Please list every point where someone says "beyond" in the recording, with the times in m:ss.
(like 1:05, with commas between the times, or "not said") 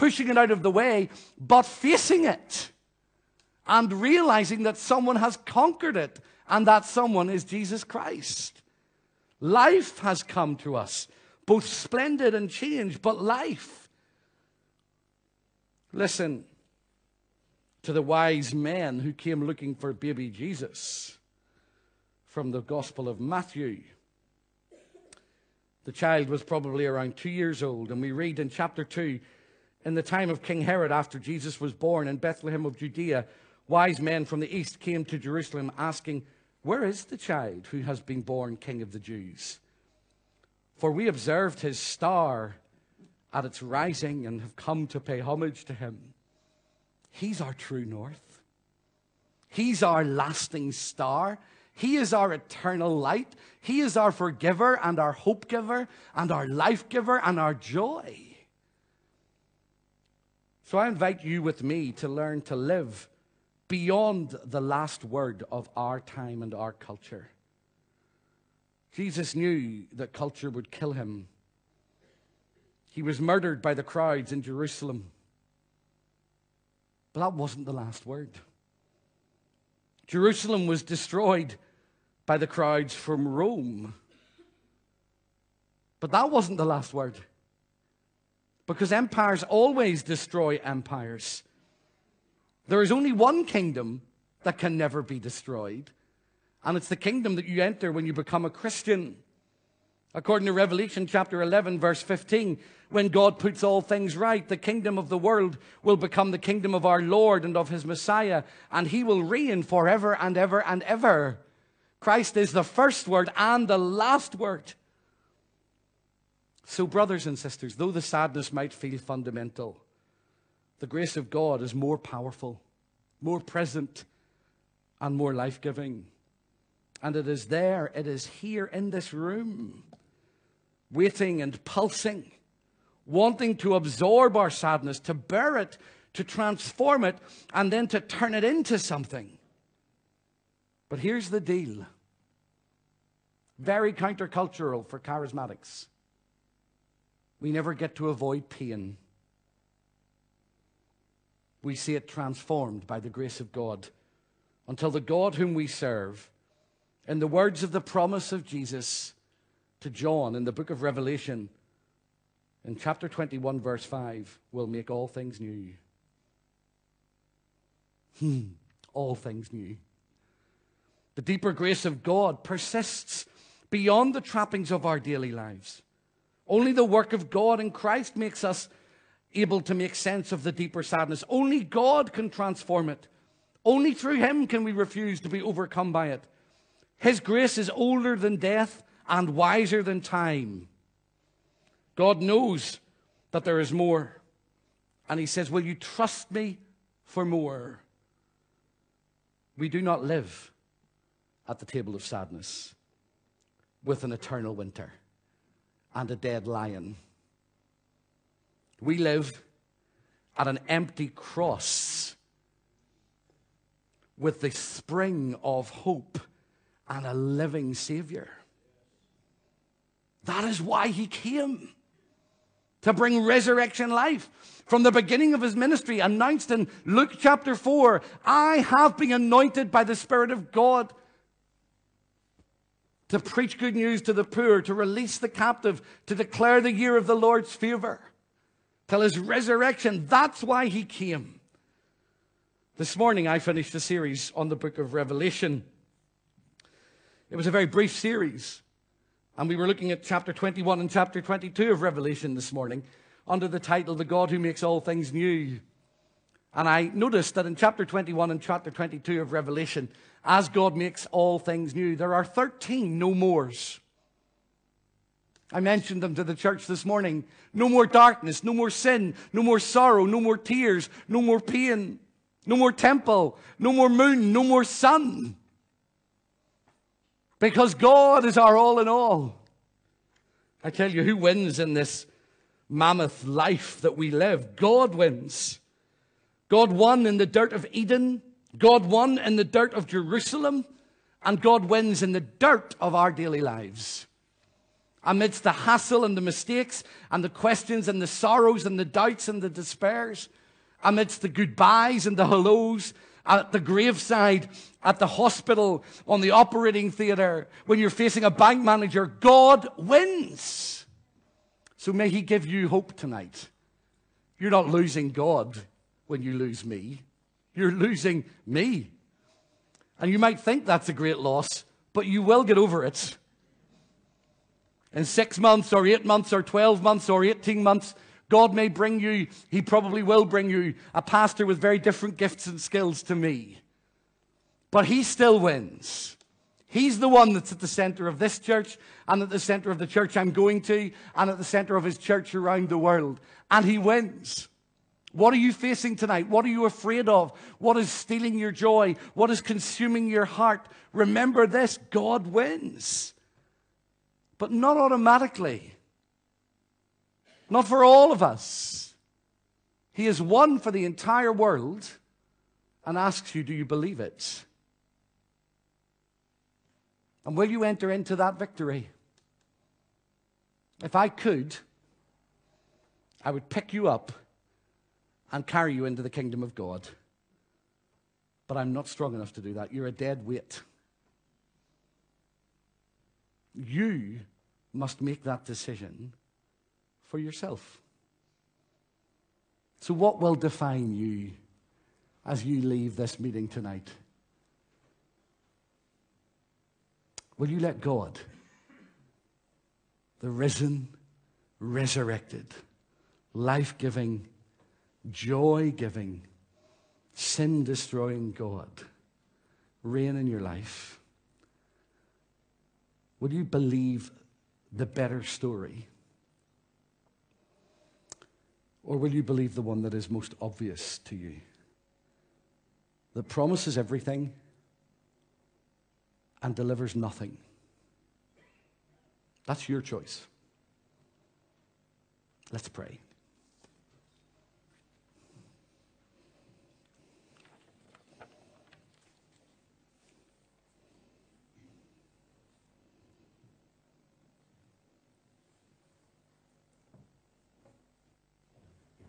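1:03, 2:53.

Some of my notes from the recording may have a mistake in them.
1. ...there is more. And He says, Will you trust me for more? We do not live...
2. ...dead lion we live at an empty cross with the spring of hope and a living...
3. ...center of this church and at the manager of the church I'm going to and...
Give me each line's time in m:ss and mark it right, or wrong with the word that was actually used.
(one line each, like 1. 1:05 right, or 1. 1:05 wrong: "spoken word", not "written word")
1. 3:13 right
2. 3:26 right
3. 5:37 wrong: "center", not "manager".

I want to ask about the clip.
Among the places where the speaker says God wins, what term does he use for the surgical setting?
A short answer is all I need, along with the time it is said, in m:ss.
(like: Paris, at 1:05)
operating theatre, at 5:06.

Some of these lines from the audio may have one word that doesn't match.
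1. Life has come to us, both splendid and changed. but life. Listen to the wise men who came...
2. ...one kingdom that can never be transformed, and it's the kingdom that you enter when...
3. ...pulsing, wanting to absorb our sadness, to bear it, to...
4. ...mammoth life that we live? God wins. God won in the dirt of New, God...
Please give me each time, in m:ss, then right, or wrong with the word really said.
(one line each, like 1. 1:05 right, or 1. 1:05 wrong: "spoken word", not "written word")
1. 0:09 right
2. 1:33 wrong: "destroyed", not "transformed"
3. 2:11 right
4. 4:42 wrong: "Eden", not "New".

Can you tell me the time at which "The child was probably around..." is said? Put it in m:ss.
0:25.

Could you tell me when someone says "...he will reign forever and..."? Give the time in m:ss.
1:48.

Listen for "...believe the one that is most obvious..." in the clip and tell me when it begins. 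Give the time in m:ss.
6:59.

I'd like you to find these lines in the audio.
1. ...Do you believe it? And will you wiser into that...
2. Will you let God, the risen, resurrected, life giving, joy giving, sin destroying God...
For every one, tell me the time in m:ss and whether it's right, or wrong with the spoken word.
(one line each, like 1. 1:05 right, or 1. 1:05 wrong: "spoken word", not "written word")
1. 6:03 wrong: "enter", not "wiser"
2. 6:37 right.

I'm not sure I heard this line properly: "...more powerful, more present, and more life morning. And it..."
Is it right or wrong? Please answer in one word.
wrong.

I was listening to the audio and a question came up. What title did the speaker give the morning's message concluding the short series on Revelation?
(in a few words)
The God Who Makes All Things New.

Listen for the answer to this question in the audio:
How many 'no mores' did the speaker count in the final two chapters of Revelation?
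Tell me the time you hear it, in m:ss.
4:22.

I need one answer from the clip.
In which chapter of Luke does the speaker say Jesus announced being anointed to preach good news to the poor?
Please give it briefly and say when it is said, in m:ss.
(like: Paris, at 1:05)
Chapter 4, at 3:46.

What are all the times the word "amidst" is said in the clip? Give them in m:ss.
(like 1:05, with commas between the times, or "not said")
4:55, 5:00.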